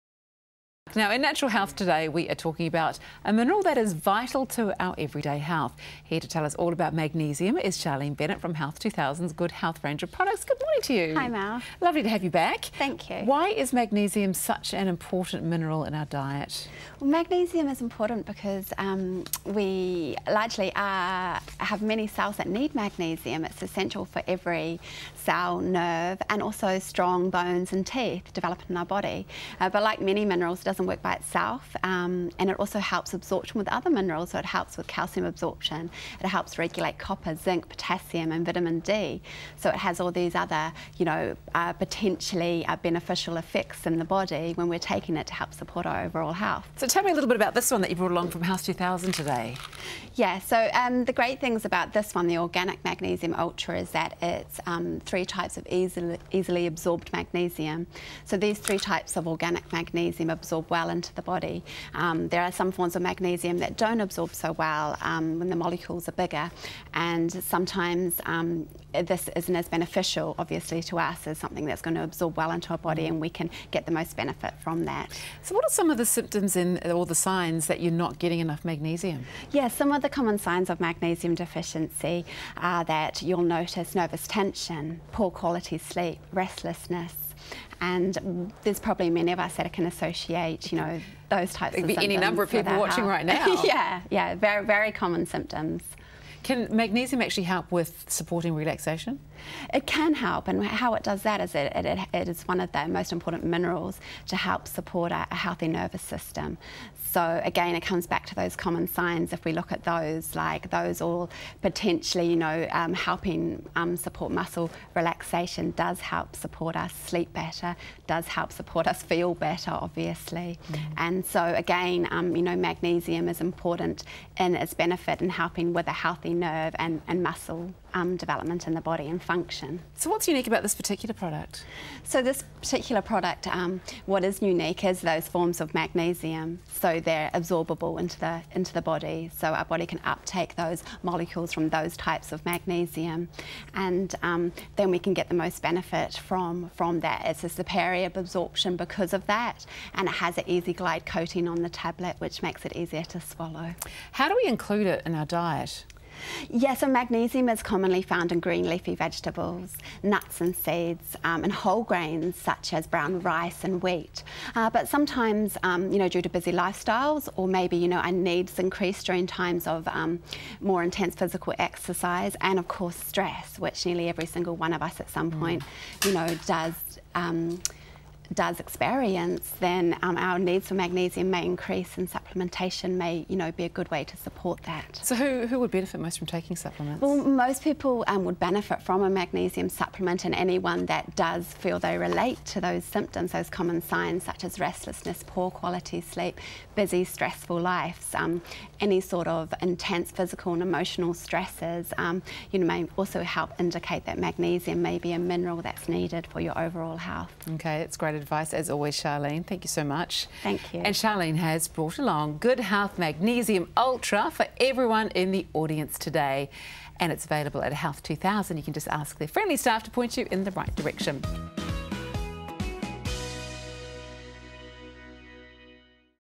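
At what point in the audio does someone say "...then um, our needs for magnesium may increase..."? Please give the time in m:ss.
2:59.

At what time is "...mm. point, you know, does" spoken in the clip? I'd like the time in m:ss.
2:55.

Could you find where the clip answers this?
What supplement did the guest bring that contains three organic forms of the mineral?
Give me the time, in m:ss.
0:52.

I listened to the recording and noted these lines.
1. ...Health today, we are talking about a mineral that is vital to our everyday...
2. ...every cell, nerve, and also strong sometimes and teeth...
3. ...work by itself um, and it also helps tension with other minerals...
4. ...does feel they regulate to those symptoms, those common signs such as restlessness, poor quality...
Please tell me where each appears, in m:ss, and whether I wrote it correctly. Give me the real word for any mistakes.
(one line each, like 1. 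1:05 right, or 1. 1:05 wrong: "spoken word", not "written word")
1. 0:01 right
2. 0:24 wrong: "bones", not "sometimes"
3. 0:30 wrong: "absorption", not "tension"
4. 3:11 wrong: "relate", not "regulate".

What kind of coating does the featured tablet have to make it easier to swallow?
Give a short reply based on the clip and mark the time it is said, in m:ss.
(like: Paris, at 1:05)
easy glide coating, at 2:30.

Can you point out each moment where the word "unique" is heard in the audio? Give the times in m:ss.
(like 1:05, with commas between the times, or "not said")
2:10, 2:14.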